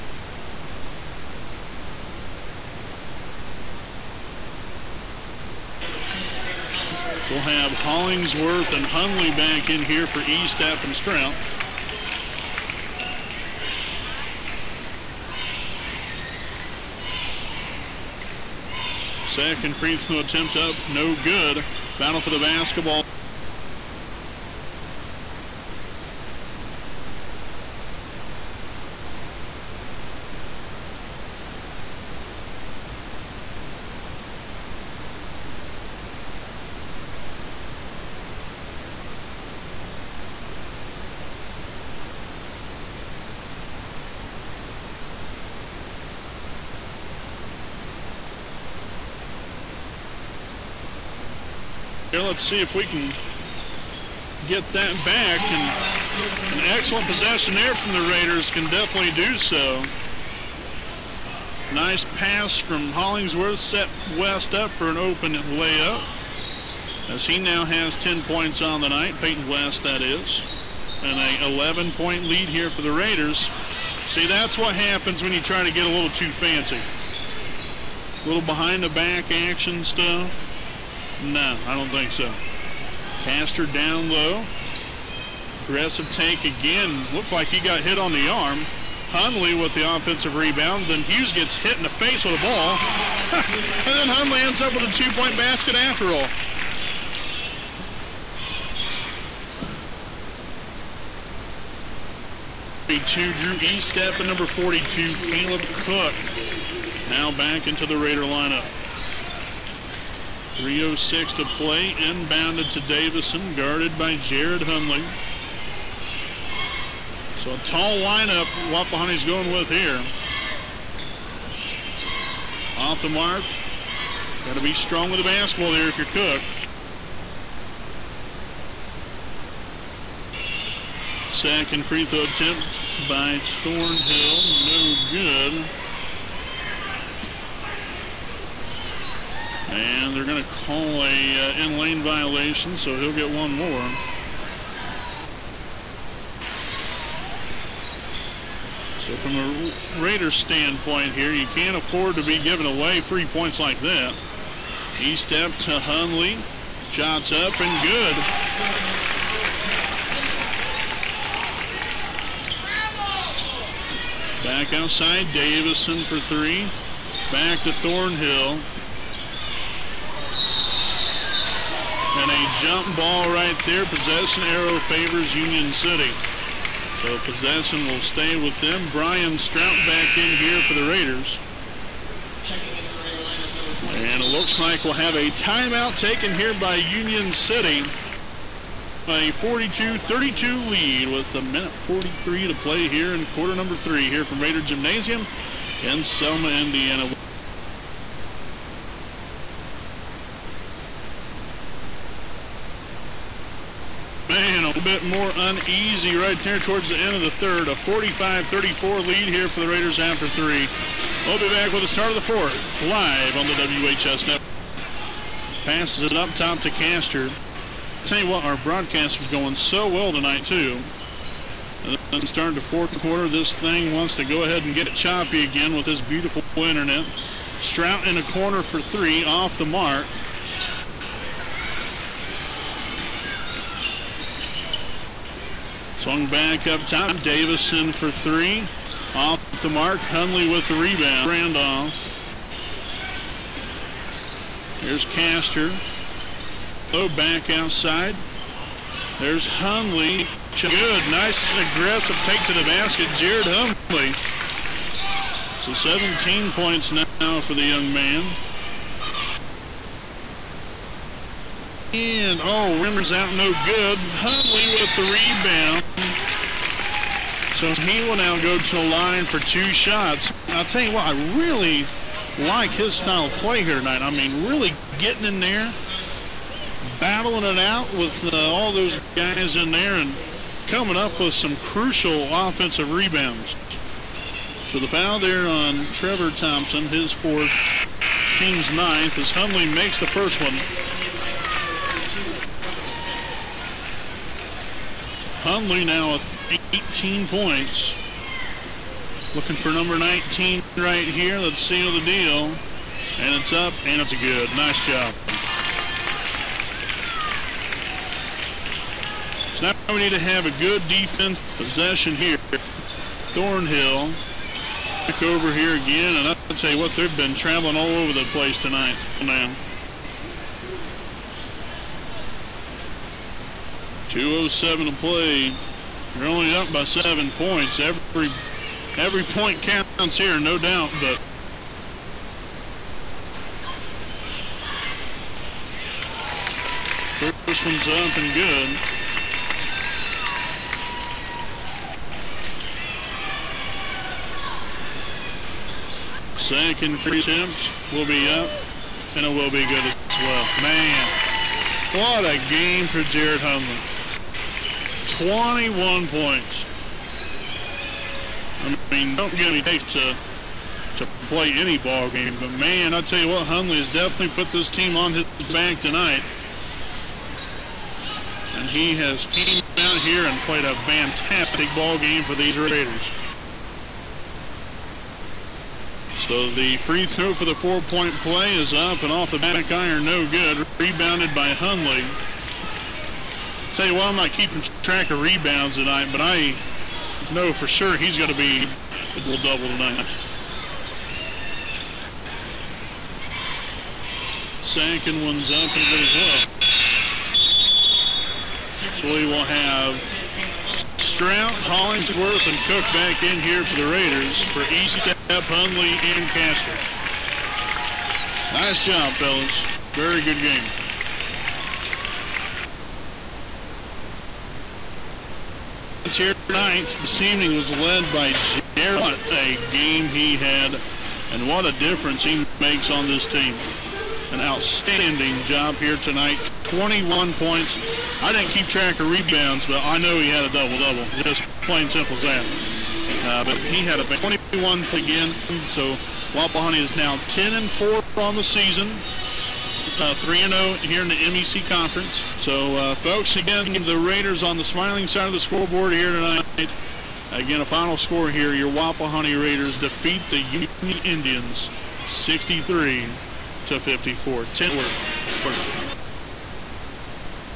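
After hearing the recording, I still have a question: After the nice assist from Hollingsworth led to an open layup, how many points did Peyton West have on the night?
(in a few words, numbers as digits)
10.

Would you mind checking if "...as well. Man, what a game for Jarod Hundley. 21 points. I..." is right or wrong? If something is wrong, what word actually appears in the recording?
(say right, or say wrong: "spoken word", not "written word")
right.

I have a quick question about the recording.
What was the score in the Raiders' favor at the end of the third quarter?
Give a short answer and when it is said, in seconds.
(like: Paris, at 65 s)
45-34, at 207 s.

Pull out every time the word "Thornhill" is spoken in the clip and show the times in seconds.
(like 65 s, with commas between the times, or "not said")
133 s, 167 s, 313 s.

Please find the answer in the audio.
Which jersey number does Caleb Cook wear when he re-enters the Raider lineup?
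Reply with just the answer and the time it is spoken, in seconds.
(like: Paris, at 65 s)
42, at 104 s.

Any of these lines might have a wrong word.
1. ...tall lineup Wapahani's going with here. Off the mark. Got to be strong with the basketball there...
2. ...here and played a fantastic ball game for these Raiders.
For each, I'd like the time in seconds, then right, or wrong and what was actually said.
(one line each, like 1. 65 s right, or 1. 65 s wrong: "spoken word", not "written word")
1. 117 s right
2. 370 s right.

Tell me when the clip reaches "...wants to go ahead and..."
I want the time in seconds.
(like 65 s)
223 s.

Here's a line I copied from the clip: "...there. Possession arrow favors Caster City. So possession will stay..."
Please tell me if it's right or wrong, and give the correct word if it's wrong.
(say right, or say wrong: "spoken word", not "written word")
wrong: "Union", not "Caster".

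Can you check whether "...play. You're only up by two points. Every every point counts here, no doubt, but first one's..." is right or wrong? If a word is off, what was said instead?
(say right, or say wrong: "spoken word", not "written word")
wrong: "seven", not "two".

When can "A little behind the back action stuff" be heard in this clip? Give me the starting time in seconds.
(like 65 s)
78 s.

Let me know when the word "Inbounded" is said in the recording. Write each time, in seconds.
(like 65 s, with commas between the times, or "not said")
111 s.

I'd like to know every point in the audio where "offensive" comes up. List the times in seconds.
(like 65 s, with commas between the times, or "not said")
89 s, 282 s.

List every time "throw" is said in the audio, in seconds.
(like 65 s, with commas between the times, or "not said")
19 s, 132 s, 377 s.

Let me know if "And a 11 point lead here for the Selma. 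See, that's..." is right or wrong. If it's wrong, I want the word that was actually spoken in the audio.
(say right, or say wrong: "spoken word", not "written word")
wrong: "Raiders", not "Selma".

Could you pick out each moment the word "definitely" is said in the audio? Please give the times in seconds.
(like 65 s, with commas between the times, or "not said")
58 s, 363 s.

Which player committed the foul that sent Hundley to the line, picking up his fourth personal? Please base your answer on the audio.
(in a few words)
Trevor Thompson.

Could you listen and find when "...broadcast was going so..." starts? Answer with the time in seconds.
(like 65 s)
218 s.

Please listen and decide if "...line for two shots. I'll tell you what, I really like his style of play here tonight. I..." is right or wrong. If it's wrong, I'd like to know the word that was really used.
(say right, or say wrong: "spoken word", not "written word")
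right.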